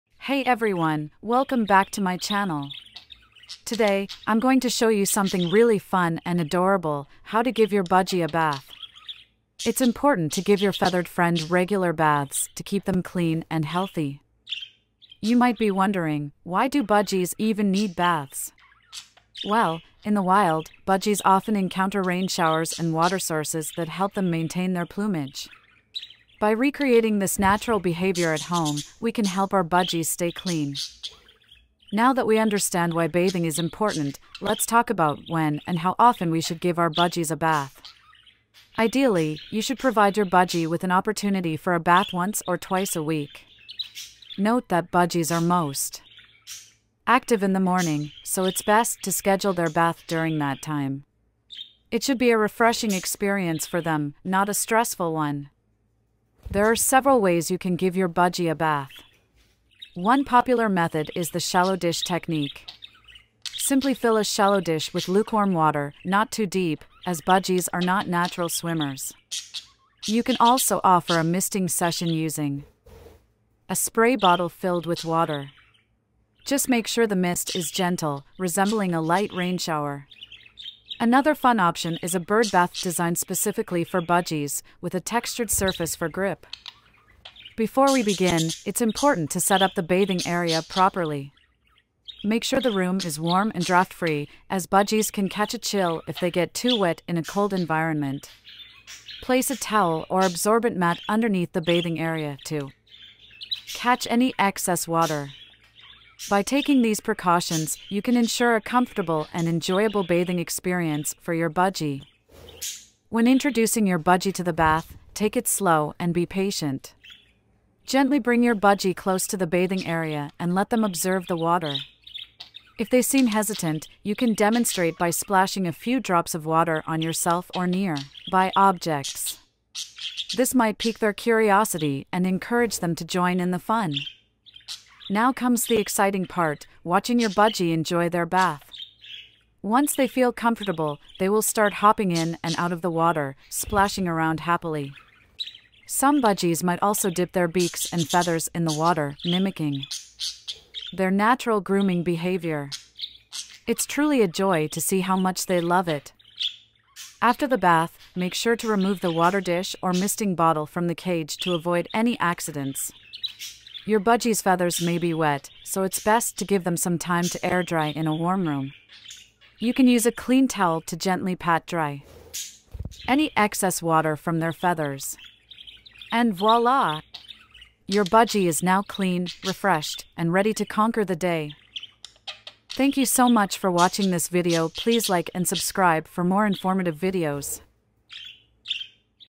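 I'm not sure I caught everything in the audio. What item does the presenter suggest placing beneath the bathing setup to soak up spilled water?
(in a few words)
Towel or absorbent mat.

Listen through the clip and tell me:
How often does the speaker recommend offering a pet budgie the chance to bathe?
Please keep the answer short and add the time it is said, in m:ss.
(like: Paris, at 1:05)
Once or twice a week, at 0:42.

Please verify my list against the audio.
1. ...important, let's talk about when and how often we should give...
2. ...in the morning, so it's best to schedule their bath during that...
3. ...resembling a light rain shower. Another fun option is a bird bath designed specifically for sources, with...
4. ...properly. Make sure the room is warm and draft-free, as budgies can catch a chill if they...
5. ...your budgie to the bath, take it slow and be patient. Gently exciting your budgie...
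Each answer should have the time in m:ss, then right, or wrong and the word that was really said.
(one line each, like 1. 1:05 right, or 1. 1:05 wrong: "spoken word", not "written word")
1. 0:33 right
2. 0:47 right
3. 1:18 wrong: "budgies", not "sources"
4. 1:30 right
5. 1:53 wrong: "bring", not "exciting".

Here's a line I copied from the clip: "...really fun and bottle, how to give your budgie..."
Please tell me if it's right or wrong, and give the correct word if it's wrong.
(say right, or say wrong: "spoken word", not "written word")
wrong: "adorable", not "bottle".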